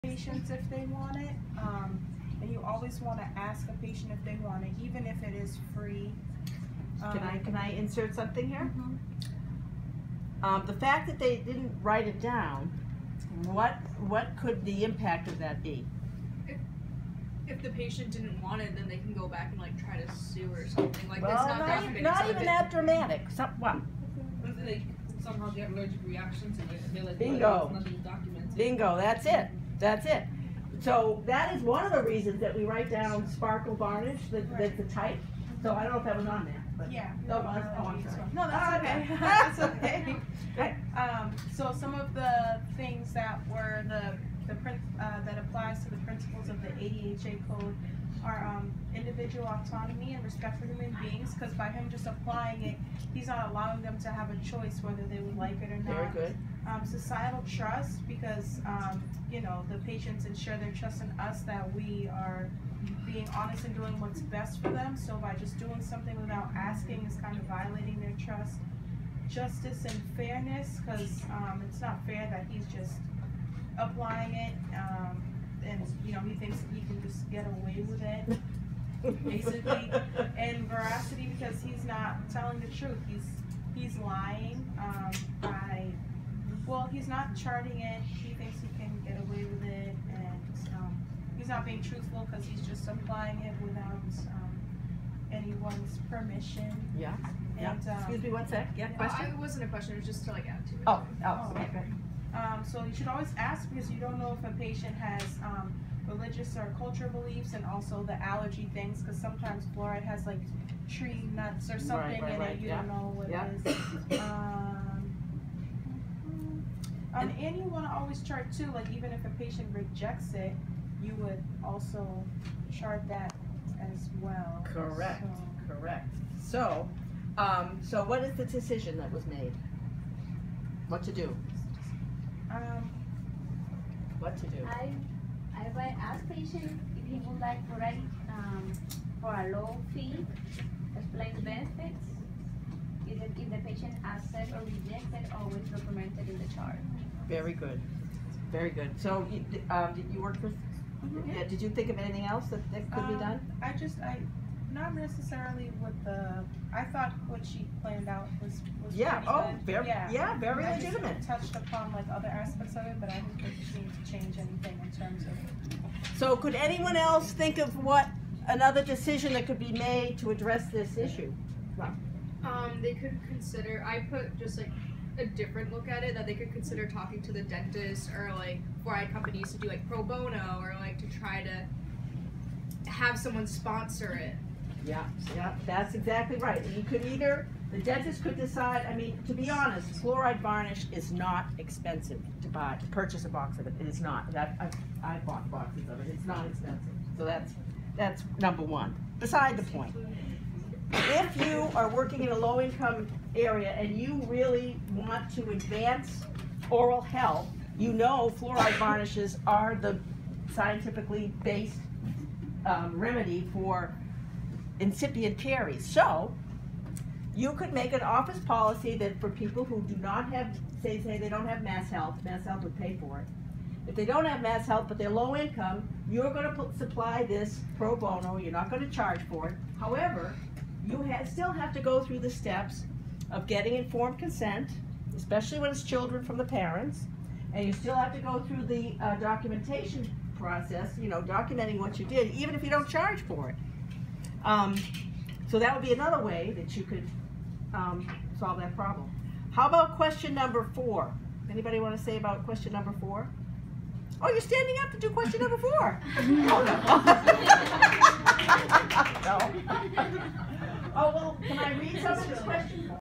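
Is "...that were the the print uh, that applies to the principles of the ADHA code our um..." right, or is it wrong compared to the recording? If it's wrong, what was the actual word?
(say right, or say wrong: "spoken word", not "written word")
right.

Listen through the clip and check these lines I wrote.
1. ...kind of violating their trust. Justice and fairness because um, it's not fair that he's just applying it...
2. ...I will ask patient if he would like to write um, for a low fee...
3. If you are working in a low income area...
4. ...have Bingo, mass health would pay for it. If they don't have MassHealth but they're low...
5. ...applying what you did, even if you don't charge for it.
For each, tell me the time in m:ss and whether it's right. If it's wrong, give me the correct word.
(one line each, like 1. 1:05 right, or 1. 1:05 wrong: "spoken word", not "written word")
1. 1:07 right
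2. 2:15 right
3. 3:20 right
4. 3:41 wrong: "MassHealth", not "Bingo"
5. 4:01 wrong: "documenting", not "applying".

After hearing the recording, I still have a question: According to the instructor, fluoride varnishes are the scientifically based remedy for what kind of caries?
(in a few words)
Incipient caries.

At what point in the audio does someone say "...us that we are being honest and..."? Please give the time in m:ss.
1:01.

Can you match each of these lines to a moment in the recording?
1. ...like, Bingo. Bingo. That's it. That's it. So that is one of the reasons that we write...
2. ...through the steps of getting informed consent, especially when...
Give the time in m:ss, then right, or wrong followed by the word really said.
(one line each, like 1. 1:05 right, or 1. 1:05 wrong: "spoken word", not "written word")
1. 0:27 right
2. 3:52 right.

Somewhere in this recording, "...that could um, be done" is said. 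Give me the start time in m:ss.
2:32.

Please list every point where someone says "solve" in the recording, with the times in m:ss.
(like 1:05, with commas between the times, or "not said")
4:08.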